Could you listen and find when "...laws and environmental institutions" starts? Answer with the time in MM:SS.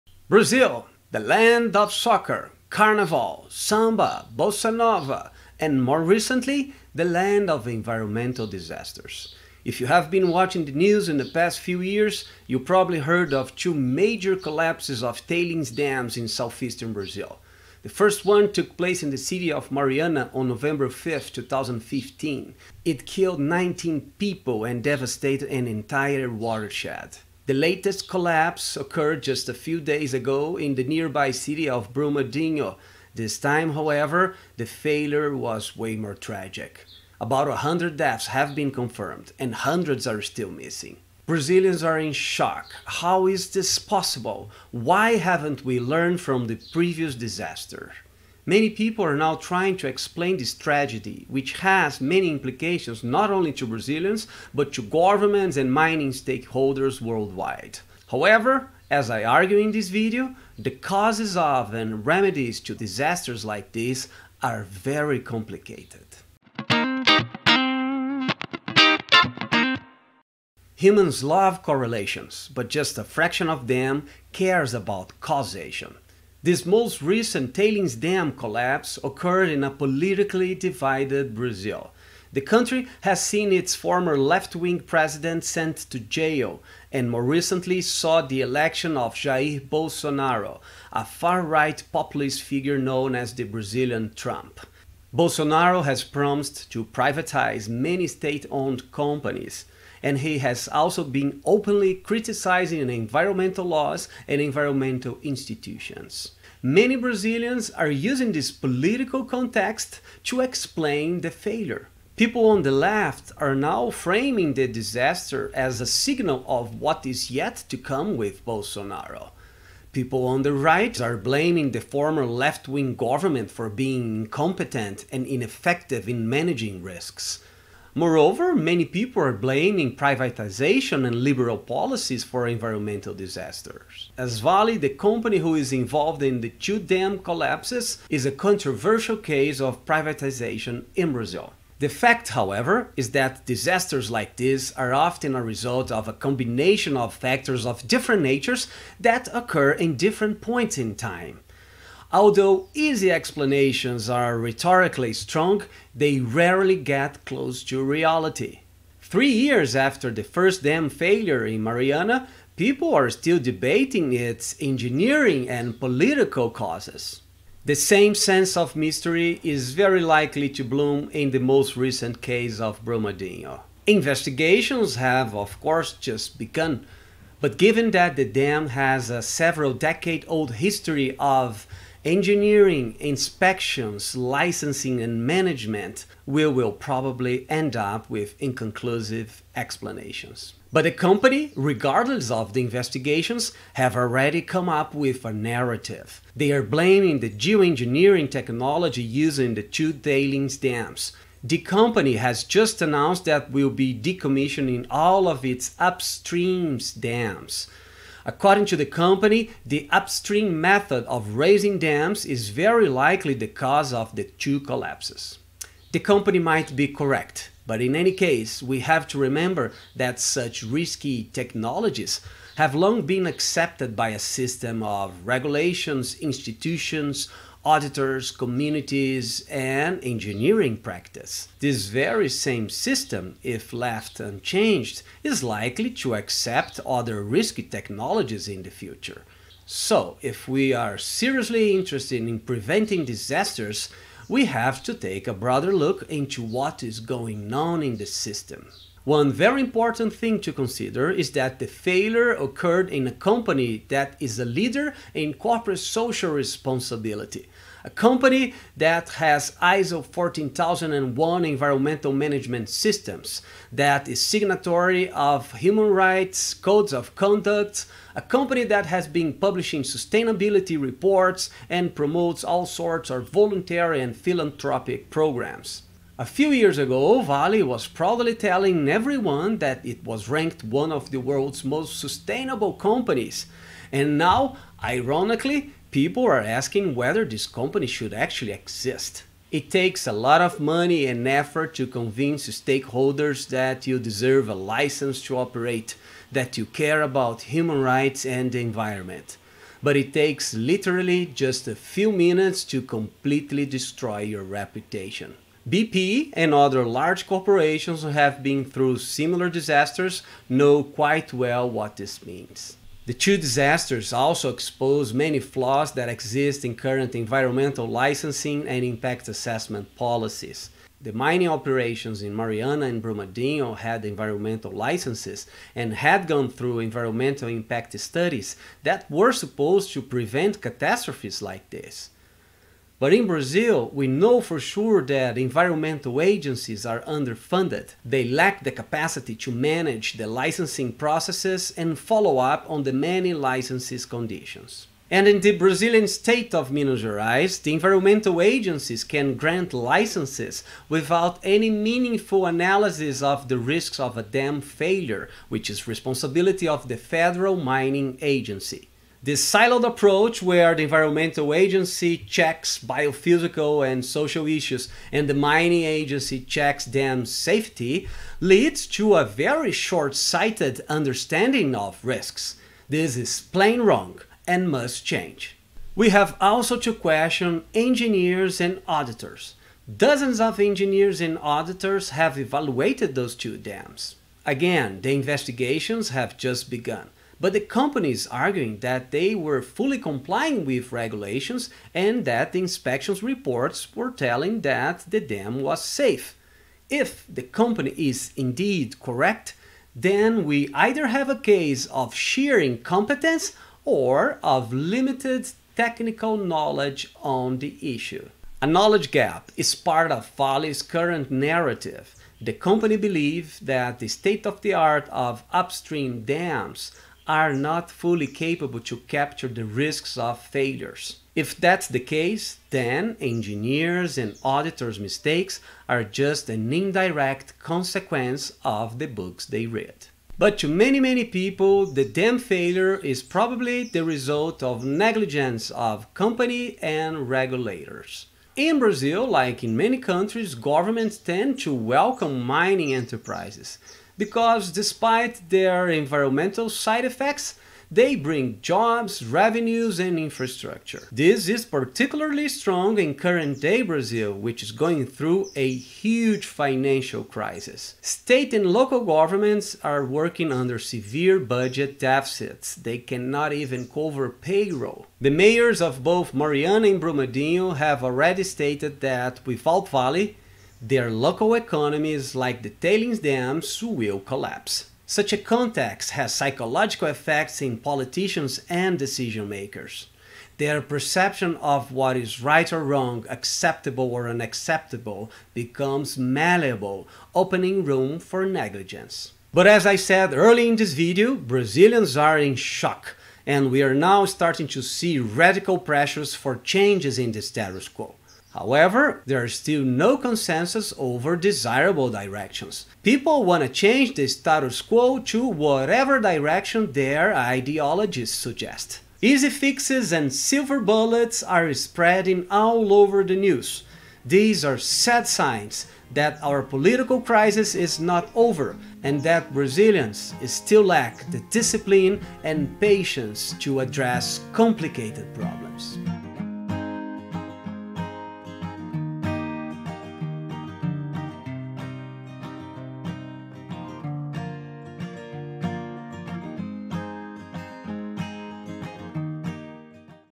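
01:43.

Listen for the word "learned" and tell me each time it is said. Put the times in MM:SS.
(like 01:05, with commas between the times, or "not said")
00:45.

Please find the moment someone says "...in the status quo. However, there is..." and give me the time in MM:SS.
08:17.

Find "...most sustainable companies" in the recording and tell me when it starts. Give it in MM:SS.
04:41.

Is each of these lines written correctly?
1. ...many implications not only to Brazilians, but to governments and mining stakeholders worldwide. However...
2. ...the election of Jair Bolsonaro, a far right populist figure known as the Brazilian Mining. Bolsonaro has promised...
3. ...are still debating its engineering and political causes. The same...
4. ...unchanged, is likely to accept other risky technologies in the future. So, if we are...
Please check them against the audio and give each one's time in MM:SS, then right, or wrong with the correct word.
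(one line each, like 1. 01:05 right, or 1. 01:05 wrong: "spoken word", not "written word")
1. 00:52 right
2. 01:28 wrong: "Trump", not "Mining"
3. 02:42 right
4. 03:54 right.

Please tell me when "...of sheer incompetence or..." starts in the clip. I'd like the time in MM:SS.
06:41.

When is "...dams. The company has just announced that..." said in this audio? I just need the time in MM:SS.
03:20.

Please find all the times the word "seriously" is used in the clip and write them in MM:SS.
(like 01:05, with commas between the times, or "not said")
04:00.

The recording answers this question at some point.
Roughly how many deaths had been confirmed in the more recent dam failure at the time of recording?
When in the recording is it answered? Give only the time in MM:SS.
00:37.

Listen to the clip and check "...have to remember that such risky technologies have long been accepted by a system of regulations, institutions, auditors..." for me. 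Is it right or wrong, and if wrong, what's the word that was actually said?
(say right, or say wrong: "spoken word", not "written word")
right.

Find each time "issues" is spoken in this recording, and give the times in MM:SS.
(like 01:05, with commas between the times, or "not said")
06:04, 06:47.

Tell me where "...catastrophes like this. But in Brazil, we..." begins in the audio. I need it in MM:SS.
05:30.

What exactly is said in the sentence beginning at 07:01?
If that's the case, then engineers and auditors' mistakes are just an indirect consequence of the books they read.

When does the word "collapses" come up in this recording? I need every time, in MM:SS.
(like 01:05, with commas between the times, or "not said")
00:14, 00:28, 01:18, 02:17, 03:34, 07:54.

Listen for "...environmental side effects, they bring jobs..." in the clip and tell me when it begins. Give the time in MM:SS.
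07:25.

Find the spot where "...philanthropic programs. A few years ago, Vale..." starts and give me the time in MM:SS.
04:34.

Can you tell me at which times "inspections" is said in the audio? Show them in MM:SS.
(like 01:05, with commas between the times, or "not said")
03:02, 06:32.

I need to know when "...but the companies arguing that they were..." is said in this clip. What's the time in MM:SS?
06:27.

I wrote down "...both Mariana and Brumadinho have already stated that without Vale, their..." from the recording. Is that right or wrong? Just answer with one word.
right.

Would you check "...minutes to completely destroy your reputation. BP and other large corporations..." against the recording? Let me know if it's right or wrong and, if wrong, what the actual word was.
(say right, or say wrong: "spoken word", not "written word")
right.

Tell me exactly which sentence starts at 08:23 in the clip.
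People want to change the status quo to whatever direction their ideologies suggest.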